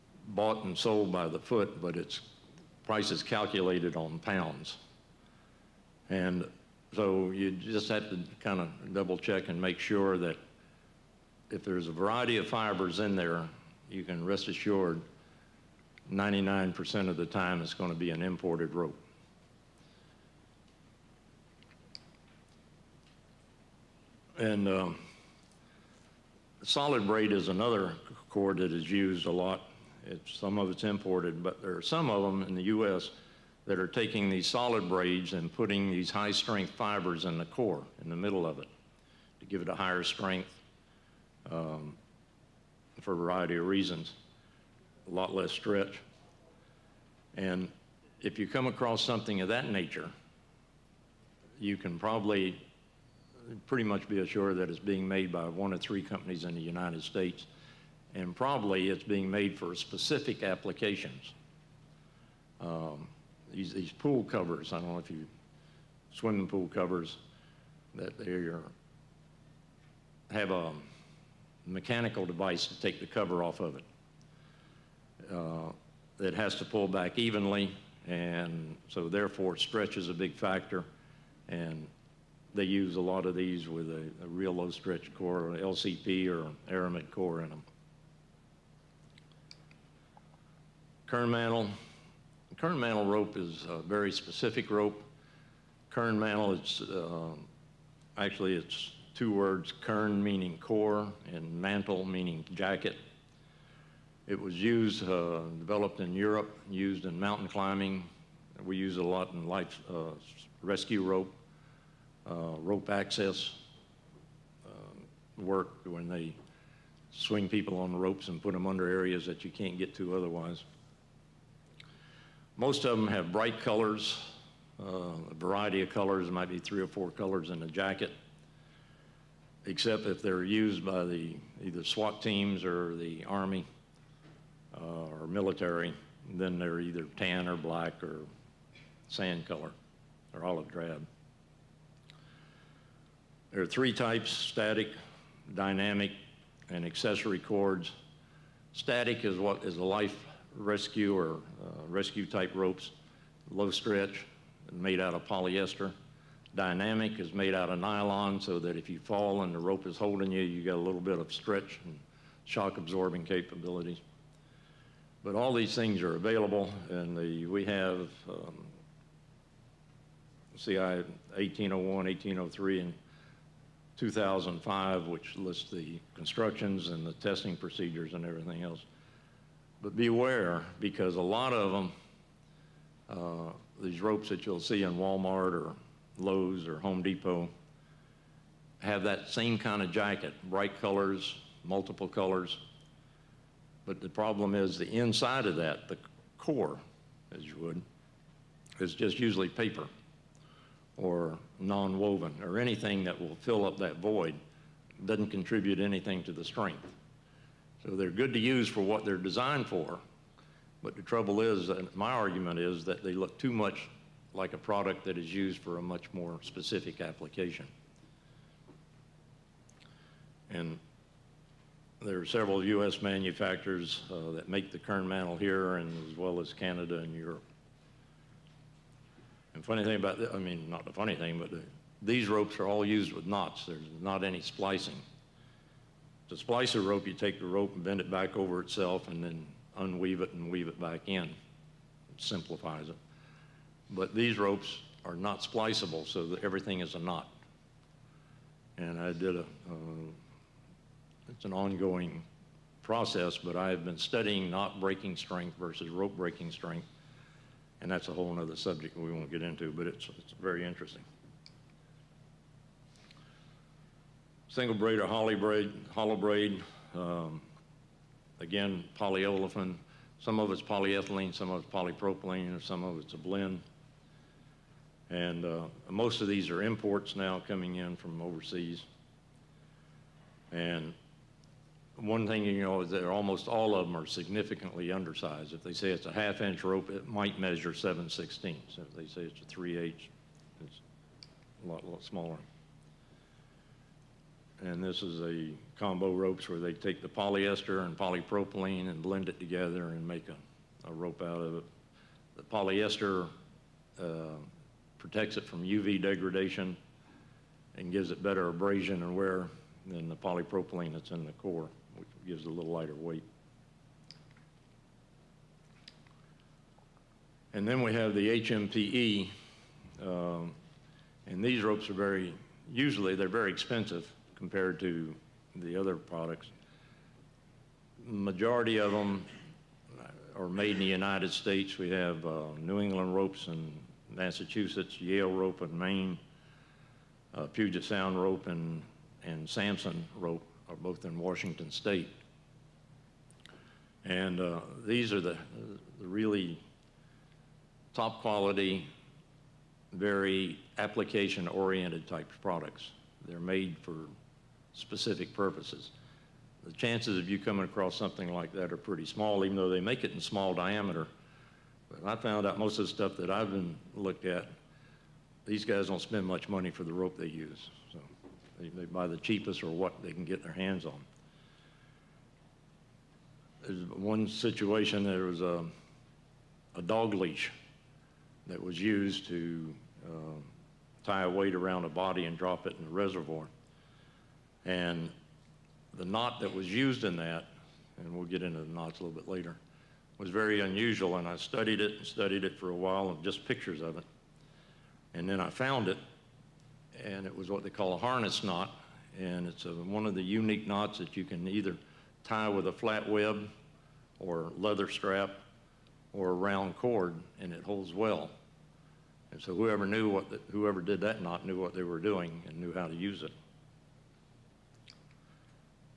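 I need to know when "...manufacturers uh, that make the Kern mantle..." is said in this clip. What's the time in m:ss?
3:43.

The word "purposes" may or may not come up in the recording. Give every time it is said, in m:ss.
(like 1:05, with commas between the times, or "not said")
5:55.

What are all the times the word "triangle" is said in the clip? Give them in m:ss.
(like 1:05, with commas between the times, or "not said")
not said.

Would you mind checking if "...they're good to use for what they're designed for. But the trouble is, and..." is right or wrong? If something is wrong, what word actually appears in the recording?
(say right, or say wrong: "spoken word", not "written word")
right.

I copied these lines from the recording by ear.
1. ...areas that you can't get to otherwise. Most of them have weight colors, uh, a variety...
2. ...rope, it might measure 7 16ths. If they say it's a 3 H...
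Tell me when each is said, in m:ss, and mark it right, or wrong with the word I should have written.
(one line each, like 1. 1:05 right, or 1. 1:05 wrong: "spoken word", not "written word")
1. 1:58 wrong: "bright", not "weight"
2. 4:46 right.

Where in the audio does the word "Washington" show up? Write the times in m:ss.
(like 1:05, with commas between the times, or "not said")
5:41.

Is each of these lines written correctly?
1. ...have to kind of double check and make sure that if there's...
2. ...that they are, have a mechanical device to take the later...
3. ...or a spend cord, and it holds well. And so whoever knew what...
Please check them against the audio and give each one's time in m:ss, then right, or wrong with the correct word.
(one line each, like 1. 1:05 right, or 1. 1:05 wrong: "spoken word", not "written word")
1. 0:07 right
2. 1:07 wrong: "cover", not "later"
3. 6:46 wrong: "round", not "spend".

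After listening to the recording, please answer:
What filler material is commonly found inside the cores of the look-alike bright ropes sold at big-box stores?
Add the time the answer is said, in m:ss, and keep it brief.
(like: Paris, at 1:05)
paper, at 3:19.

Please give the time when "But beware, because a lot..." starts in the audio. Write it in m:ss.
2:59.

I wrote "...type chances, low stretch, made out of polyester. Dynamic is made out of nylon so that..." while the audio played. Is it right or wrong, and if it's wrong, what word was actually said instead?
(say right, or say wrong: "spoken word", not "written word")
wrong: "ropes", not "chances".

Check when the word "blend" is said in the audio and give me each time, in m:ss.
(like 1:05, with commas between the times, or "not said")
4:33, 4:59.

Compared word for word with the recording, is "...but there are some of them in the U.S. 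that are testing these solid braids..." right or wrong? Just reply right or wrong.
wrong.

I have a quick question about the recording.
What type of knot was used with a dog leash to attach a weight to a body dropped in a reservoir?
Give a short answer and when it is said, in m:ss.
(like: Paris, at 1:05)
harness knot, at 6:37.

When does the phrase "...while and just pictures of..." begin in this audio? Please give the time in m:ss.
6:32.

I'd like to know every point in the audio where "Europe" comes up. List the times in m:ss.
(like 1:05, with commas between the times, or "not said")
1:46, 3:47.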